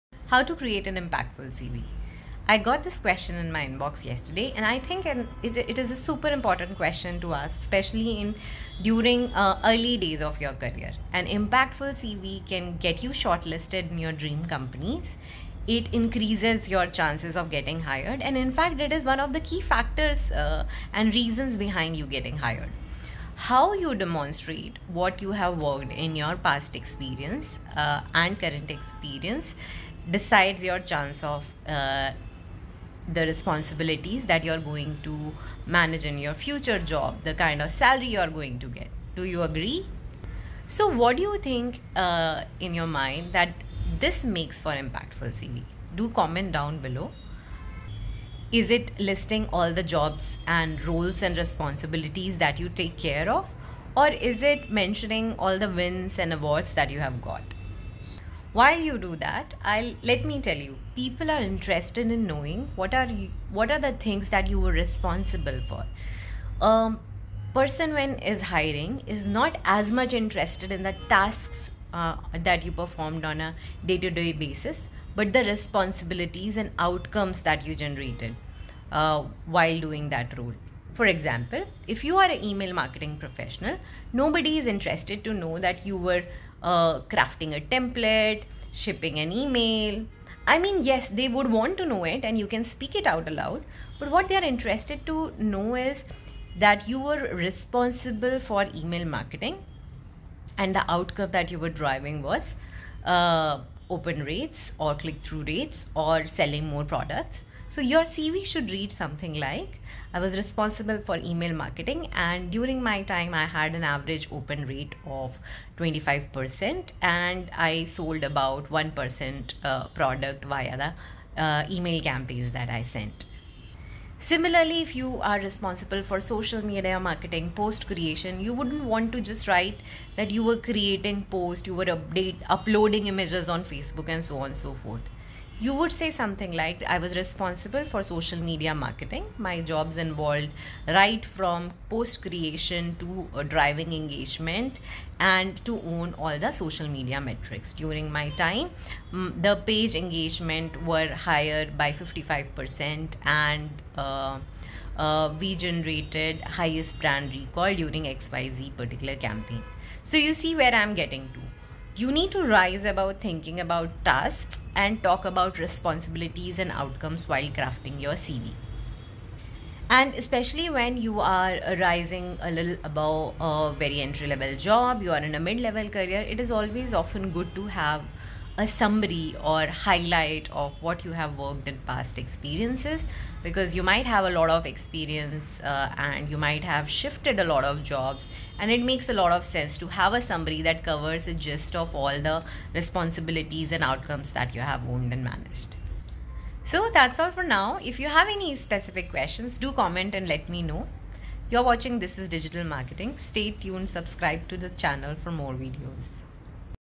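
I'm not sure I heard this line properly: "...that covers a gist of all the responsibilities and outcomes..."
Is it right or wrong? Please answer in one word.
right.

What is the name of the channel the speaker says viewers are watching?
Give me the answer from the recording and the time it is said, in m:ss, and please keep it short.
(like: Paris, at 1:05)
This is Digital Marketing, at 3:21.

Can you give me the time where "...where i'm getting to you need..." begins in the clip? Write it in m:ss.
2:40.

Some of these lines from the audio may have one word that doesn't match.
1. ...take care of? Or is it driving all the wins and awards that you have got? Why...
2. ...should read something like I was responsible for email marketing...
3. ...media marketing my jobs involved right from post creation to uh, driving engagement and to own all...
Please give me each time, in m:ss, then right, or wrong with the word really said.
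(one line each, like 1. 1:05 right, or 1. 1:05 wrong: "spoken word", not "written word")
1. 0:52 wrong: "mentioning", not "driving"
2. 1:48 right
3. 2:18 right.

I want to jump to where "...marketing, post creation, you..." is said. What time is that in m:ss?
2:06.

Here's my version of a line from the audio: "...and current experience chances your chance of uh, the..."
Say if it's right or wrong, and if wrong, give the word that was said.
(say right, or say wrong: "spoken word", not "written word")
wrong: "decides", not "chances".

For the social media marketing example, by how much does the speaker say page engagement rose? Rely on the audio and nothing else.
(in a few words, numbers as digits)
55%.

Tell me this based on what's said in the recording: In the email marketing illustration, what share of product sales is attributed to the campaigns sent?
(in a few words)
1%.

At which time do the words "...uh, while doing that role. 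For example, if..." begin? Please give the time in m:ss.
1:18.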